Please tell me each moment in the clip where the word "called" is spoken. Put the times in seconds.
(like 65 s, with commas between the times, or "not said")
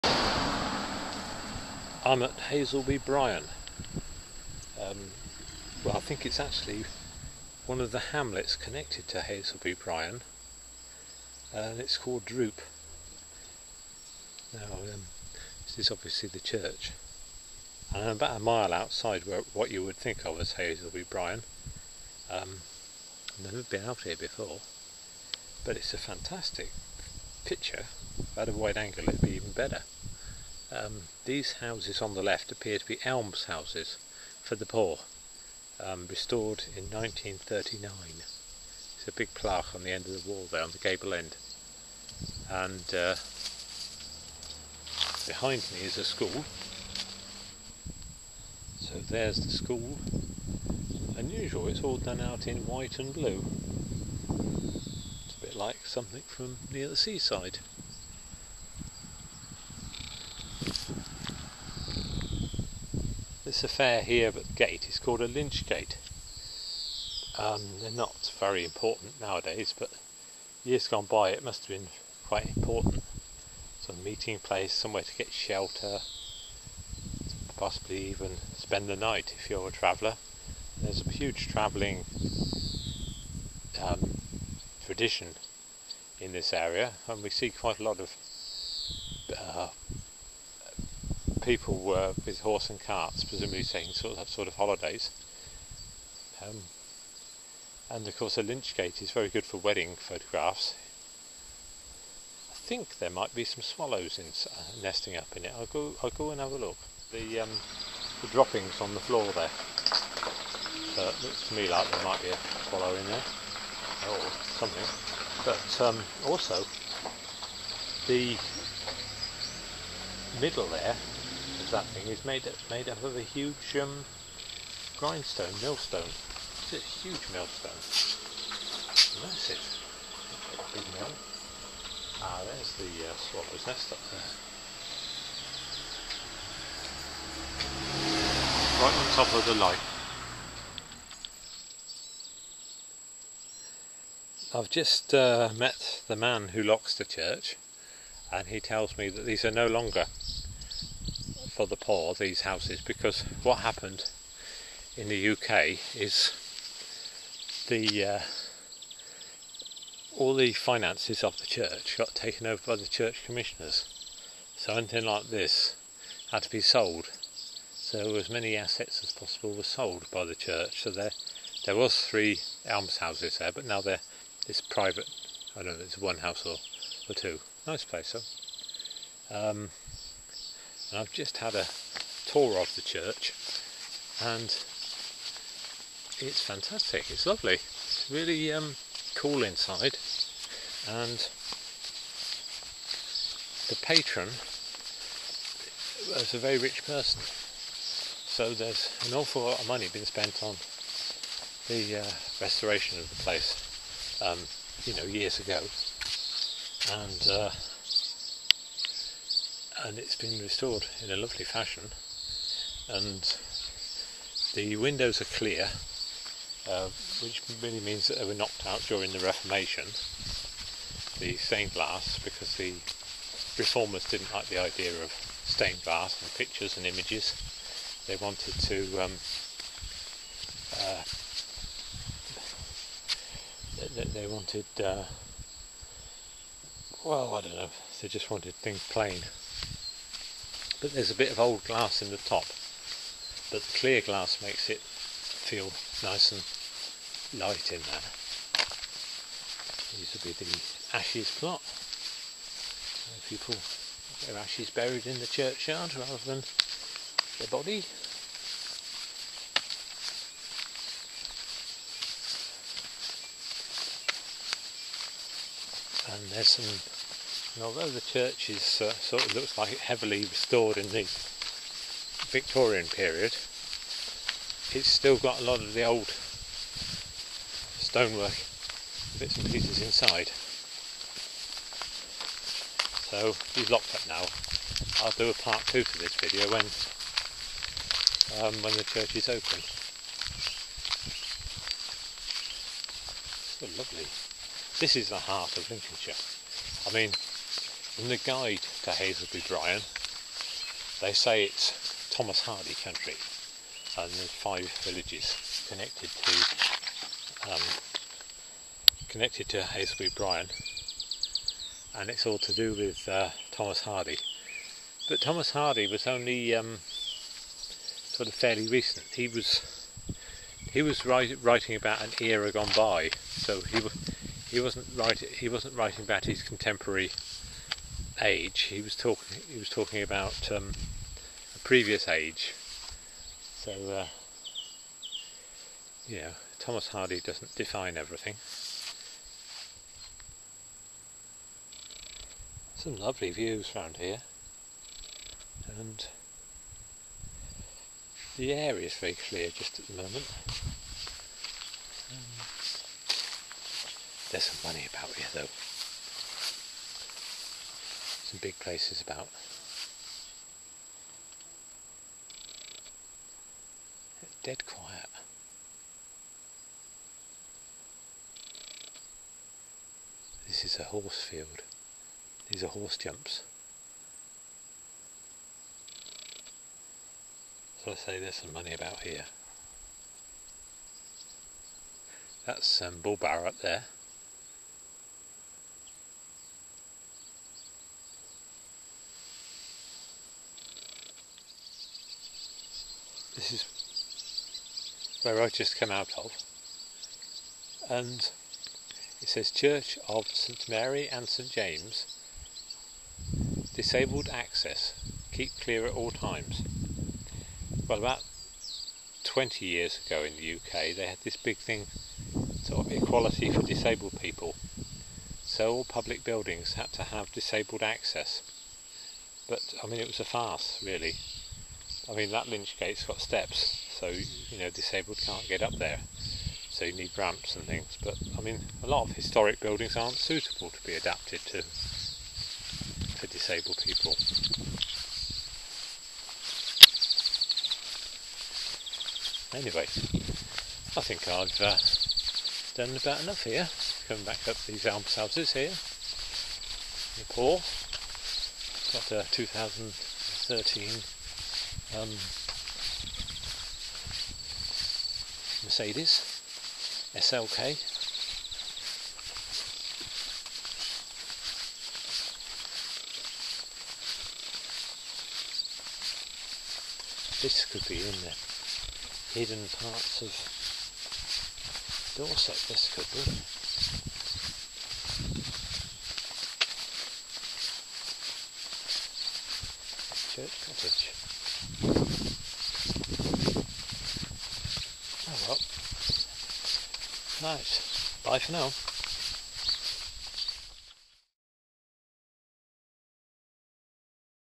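11 s, 64 s.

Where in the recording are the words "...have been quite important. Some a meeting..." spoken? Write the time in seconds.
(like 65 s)
71 s.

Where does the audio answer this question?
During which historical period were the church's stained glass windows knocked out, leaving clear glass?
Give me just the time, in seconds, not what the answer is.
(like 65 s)
219 s.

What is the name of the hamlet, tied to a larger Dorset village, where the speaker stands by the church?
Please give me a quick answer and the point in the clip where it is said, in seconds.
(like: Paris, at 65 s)
Droop, at 12 s.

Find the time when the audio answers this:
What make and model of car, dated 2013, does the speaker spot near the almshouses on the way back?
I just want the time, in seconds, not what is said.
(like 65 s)
455 s.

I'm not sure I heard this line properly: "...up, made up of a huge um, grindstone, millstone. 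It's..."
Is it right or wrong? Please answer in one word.
right.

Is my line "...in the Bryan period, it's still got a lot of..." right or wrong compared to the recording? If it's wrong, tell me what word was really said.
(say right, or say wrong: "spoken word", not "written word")
wrong: "Victorian", not "Bryan".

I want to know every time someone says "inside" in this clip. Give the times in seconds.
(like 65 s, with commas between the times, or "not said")
189 s, 279 s.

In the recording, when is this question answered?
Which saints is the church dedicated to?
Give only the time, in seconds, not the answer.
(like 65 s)
400 s.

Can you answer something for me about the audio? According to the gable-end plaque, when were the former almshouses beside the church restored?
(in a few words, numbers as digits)
1939.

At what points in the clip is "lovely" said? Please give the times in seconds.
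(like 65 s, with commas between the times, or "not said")
187 s, 211 s, 293 s, 342 s.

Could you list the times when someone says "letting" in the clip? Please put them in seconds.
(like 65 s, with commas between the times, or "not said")
not said.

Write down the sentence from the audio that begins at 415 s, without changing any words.
So all public buildings had to have disabled access.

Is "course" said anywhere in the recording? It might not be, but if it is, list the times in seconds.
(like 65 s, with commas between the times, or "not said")
98 s.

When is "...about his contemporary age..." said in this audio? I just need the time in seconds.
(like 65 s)
326 s.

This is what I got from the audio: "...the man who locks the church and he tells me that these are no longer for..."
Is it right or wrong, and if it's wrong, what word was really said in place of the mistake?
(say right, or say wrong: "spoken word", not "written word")
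right.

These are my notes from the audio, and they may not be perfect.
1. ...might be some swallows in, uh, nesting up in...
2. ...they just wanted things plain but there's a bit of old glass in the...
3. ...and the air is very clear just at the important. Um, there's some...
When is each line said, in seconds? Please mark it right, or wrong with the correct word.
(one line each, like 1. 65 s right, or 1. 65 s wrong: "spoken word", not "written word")
1. 103 s right
2. 238 s right
3. 345 s wrong: "moment", not "important".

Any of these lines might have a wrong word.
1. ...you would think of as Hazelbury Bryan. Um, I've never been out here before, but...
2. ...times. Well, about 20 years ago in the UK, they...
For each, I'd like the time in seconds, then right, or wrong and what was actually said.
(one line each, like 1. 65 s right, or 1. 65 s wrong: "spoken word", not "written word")
1. 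19 s right
2. 406 s right.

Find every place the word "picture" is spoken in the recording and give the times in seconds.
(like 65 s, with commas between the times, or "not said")
27 s, 226 s.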